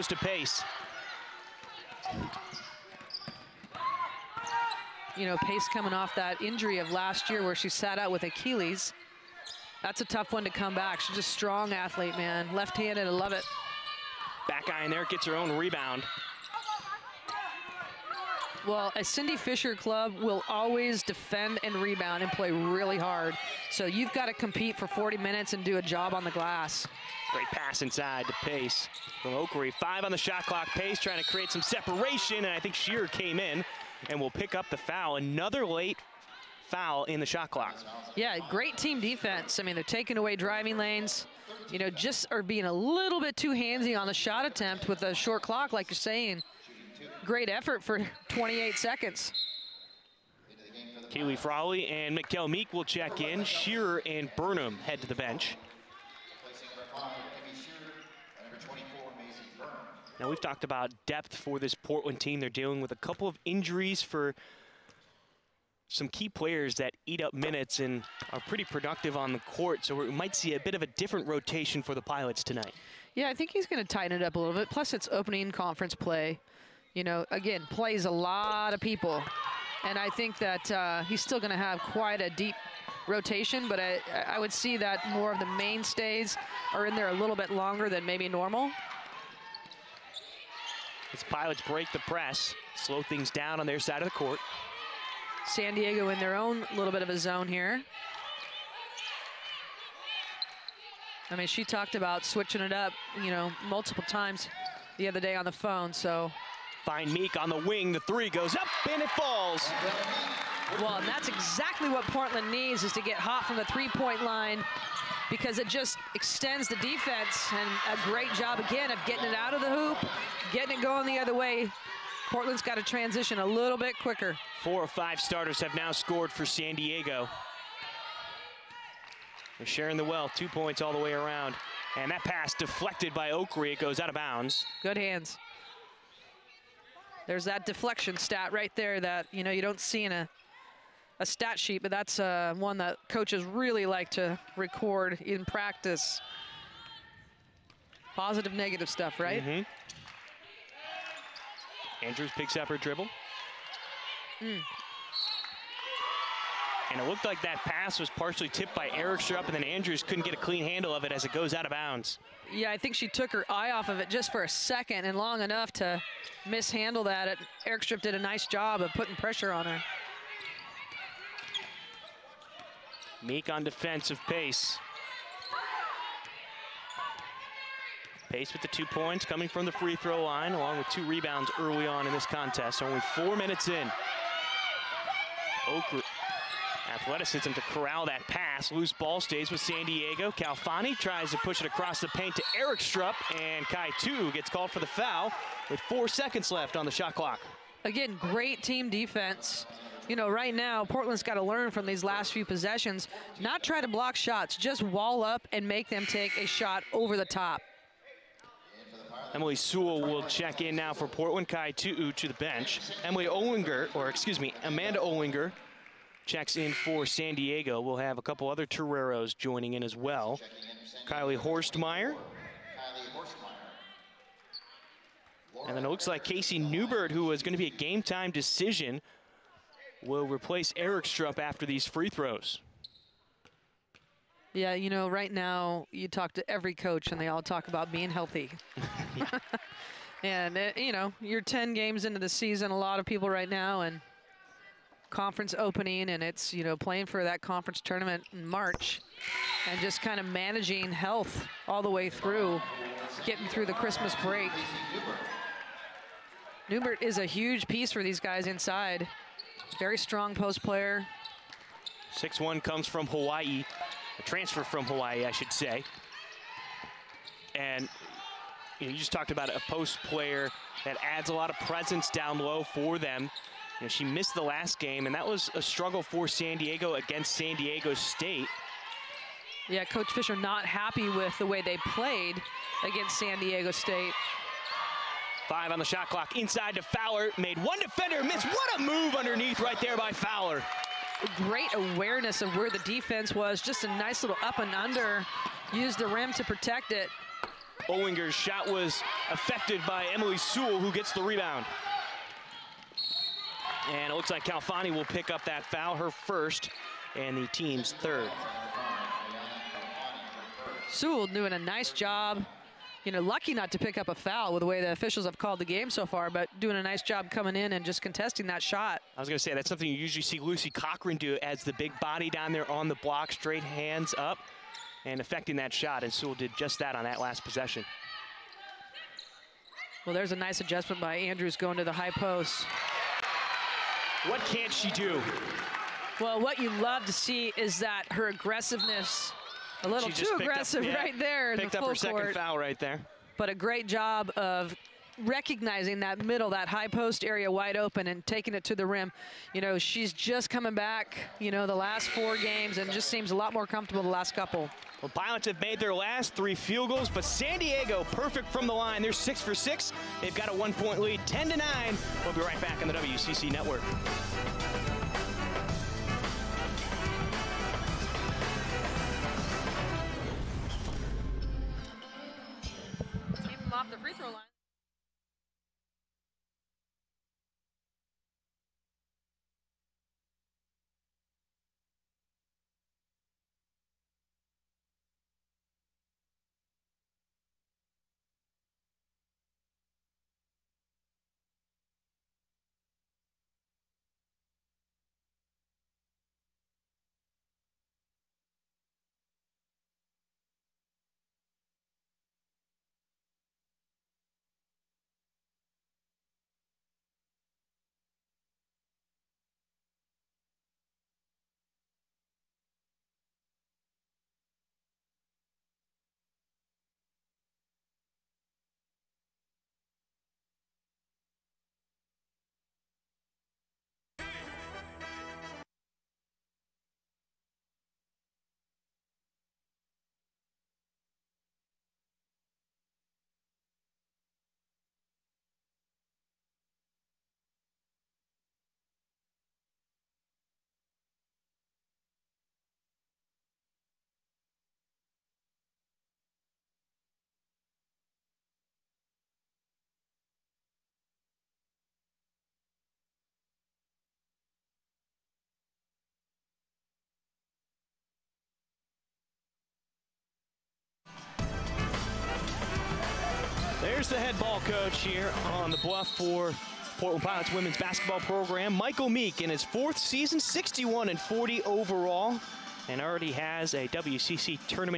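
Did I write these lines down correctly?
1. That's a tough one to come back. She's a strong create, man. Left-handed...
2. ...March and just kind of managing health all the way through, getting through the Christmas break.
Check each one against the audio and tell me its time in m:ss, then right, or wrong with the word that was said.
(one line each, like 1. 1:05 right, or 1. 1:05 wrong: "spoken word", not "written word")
1. 0:09 wrong: "athlete", not "create"
2. 4:08 right.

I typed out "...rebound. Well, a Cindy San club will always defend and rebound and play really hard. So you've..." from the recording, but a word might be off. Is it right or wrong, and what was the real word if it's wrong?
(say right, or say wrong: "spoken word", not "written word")
wrong: "Fisher", not "San".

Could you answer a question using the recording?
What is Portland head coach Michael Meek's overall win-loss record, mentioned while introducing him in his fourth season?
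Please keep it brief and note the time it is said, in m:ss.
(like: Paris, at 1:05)
61-40, at 7:50.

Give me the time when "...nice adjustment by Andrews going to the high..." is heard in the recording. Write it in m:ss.
5:30.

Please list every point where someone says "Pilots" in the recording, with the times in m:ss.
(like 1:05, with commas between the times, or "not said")
1:12, 1:31, 5:55, 7:47.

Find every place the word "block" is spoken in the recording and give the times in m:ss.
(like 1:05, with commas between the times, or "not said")
3:23, 5:22.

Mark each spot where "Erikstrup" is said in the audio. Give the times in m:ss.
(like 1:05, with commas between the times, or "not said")
2:38, 2:47, 3:12, 3:50.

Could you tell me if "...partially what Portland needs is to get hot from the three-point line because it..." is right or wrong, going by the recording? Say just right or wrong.
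wrong.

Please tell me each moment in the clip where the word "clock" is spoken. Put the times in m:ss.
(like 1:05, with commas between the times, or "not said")
0:30, 0:37, 0:45, 3:17, 4:46.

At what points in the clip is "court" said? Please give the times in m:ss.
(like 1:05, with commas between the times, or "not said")
1:09, 1:34.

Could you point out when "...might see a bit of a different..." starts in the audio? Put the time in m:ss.
1:10.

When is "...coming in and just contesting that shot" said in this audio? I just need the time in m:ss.
5:17.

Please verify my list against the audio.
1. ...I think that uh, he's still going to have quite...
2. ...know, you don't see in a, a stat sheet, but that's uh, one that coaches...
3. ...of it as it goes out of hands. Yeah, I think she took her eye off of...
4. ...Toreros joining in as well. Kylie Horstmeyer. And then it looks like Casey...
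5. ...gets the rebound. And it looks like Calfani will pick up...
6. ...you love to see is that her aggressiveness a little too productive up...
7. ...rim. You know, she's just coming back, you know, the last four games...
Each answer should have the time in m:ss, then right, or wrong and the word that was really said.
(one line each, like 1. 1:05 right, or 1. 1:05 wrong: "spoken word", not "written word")
1. 1:19 right
2. 2:19 right
3. 2:40 wrong: "bounds", not "hands"
4. 3:38 right
5. 5:00 right
6. 5:36 wrong: "aggressive", not "productive"
7. 5:48 right.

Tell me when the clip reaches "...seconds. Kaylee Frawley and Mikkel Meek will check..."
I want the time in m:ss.
0:48.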